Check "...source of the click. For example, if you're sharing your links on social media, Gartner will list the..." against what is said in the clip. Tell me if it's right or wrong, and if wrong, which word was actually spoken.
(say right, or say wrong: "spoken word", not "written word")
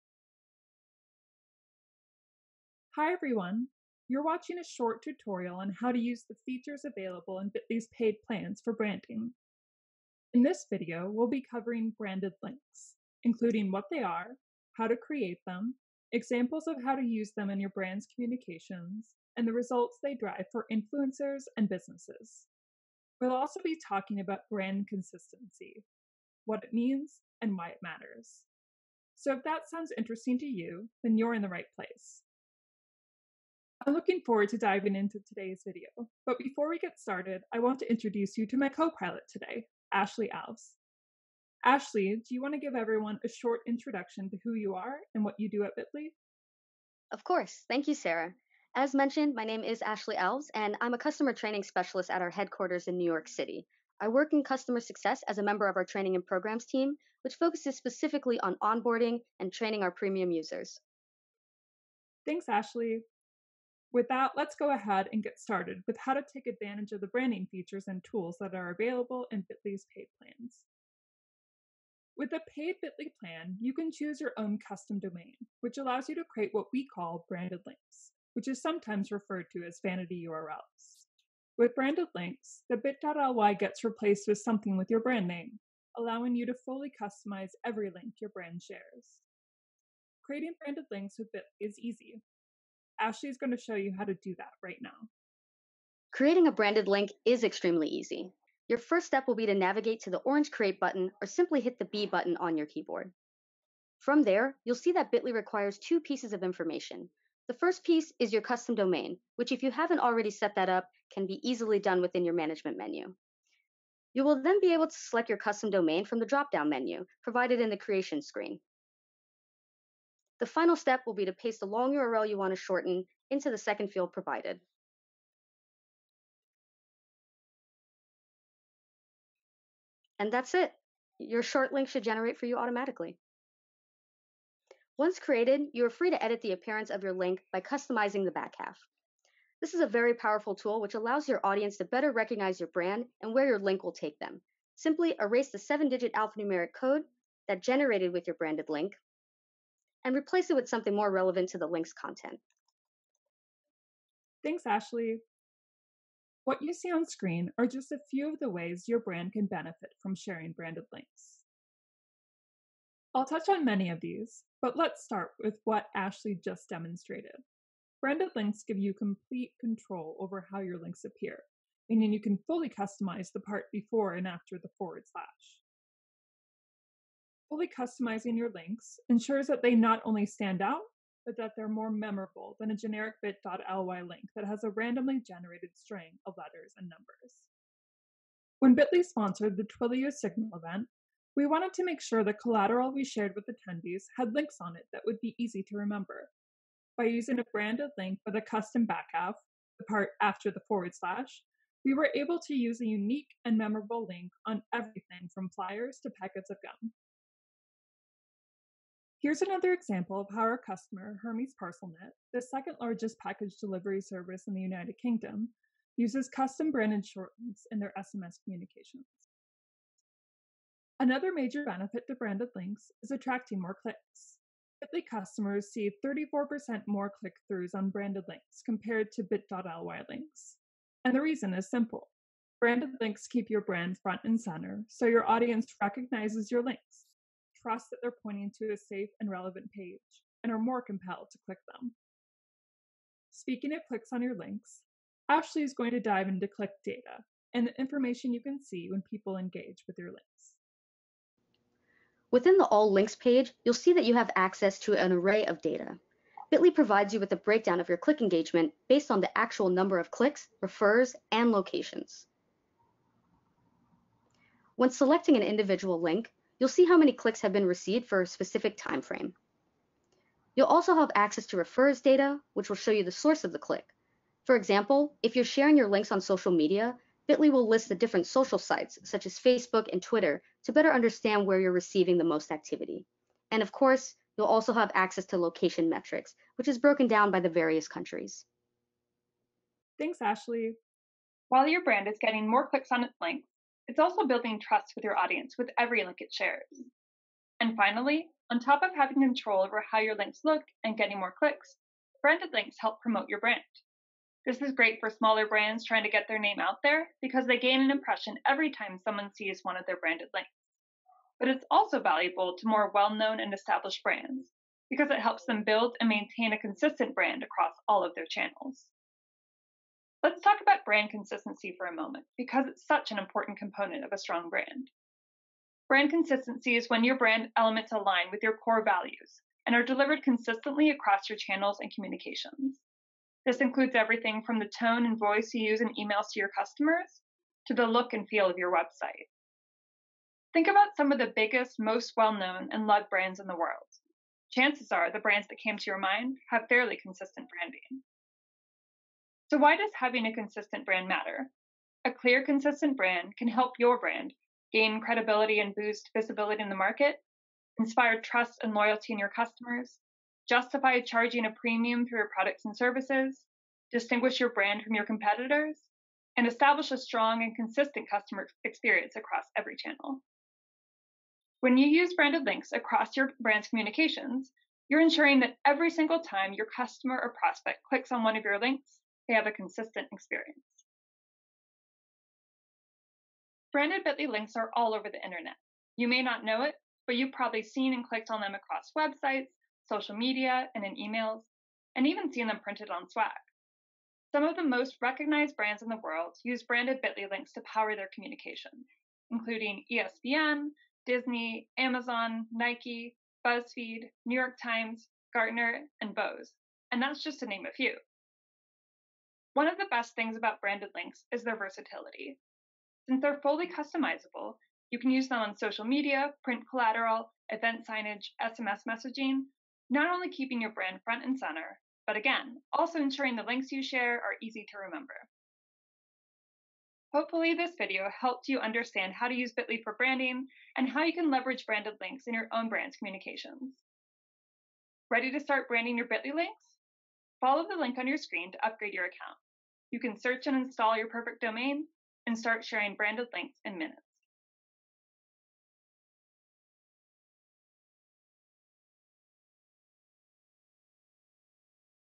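wrong: "Bitly", not "Gartner".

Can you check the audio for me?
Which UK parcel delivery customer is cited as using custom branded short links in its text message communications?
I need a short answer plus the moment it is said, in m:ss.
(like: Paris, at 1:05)
Hermes ParcelNet, at 3:31.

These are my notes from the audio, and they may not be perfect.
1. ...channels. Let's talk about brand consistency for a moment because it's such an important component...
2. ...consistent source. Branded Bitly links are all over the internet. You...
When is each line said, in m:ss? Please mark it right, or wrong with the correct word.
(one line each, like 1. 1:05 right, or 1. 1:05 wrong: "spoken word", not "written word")
1. 5:18 right
2. 6:19 wrong: "experience", not "source".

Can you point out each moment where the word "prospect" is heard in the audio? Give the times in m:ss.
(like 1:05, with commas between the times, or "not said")
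6:17.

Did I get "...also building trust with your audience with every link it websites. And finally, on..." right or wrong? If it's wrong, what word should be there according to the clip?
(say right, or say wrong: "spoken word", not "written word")
wrong: "shares", not "websites".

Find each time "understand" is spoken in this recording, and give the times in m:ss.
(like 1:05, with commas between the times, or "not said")
4:40, 7:08.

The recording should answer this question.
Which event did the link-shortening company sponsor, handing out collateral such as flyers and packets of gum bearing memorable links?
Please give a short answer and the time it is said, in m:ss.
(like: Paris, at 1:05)
Twilio Signal, at 3:09.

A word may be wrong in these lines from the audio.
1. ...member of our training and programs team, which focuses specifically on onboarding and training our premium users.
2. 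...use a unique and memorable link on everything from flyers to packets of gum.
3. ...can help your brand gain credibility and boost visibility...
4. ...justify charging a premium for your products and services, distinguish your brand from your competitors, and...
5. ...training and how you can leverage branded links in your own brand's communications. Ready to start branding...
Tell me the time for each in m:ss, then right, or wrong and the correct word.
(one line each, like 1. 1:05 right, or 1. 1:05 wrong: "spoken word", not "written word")
1. 0:55 right
2. 3:22 right
3. 5:53 right
4. 6:00 right
5. 7:09 wrong: "branding", not "training".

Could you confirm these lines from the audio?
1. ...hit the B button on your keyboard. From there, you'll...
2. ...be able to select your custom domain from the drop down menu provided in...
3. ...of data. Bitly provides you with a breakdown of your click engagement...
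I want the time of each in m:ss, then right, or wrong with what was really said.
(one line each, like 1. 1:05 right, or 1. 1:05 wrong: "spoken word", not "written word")
1. 1:41 right
2. 1:54 right
3. 4:15 right.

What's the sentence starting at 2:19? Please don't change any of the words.
This is a very powerful tool which allows your audience to better recognize your brand and where your link will take them.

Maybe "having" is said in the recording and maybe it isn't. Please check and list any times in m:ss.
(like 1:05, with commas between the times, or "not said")
4:58, 5:49.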